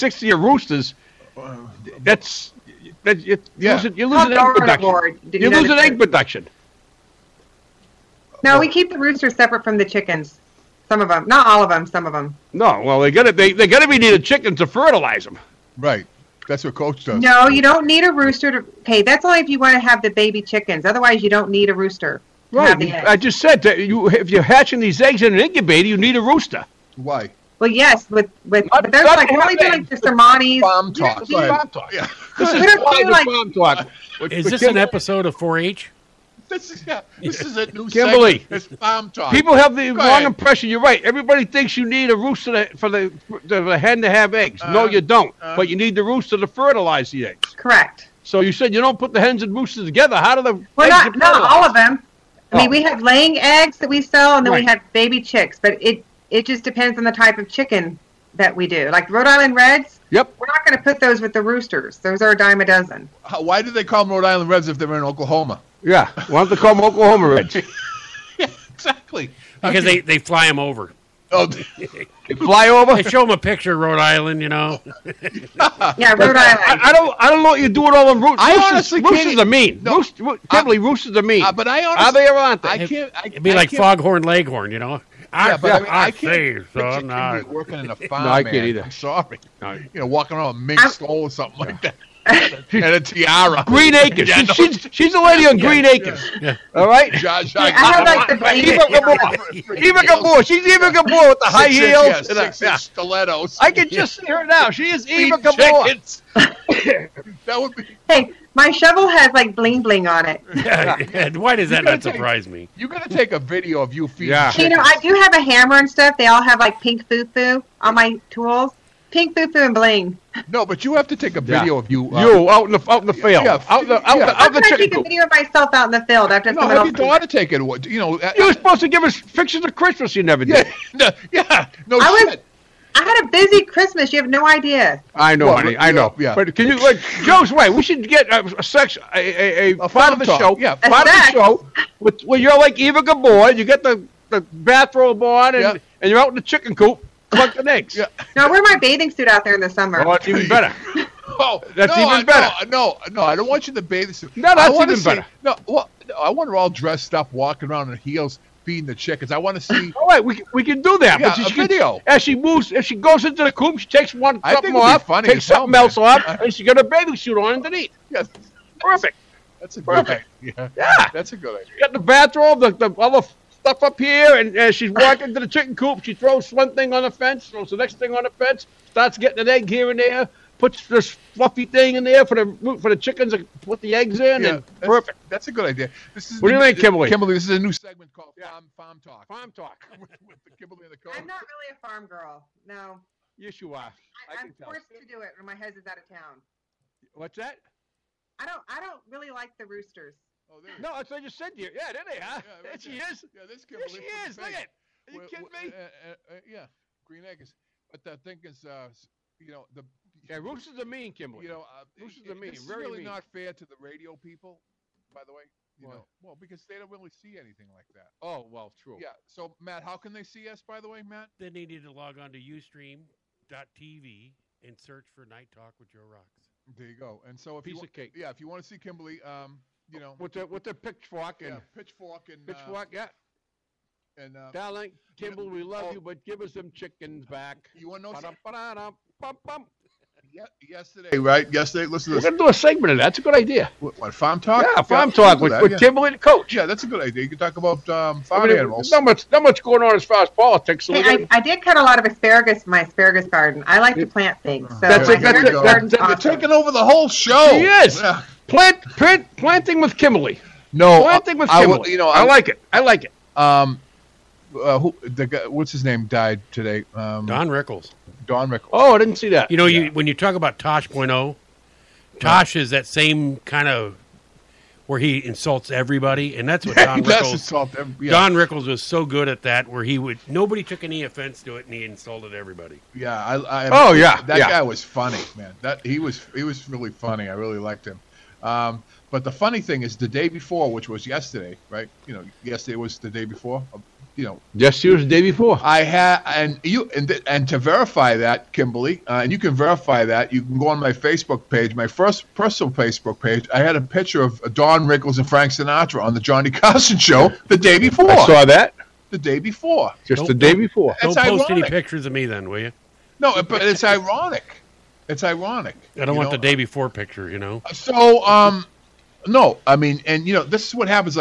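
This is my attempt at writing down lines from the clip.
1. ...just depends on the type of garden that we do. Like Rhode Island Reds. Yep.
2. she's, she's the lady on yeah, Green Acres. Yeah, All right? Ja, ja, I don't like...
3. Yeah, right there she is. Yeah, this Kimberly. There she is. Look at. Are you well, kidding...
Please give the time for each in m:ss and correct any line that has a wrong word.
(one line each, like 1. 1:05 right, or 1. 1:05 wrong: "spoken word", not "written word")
1. 0:56 wrong: "chicken", not "garden"
2. 1:34 right
3. 3:22 right.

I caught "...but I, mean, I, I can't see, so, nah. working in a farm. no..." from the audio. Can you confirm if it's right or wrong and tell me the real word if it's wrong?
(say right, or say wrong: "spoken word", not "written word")
right.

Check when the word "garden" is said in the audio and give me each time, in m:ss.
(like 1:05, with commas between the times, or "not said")
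4:13.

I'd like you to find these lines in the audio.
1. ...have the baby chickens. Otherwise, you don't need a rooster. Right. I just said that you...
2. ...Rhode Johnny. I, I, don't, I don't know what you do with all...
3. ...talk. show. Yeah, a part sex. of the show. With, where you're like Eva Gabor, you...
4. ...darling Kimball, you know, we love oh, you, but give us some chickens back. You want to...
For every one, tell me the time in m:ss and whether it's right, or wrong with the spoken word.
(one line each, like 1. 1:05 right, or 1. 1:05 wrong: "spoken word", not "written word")
1. 0:19 right
2. 1:16 wrong: "Island", not "Johnny"
3. 2:20 right
4. 3:54 right.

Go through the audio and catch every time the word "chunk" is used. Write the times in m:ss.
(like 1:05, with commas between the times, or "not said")
not said.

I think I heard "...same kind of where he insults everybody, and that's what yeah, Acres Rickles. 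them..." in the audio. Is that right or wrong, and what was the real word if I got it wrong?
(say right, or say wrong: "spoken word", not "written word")
wrong: "Don", not "Acres".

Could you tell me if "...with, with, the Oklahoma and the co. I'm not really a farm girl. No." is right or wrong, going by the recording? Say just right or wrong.
wrong.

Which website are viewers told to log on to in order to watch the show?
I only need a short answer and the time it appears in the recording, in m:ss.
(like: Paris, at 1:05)
UStream.tv, at 3:42.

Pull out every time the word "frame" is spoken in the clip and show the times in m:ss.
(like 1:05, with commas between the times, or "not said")
not said.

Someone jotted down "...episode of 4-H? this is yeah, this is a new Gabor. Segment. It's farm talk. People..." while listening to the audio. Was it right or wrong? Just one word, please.
wrong.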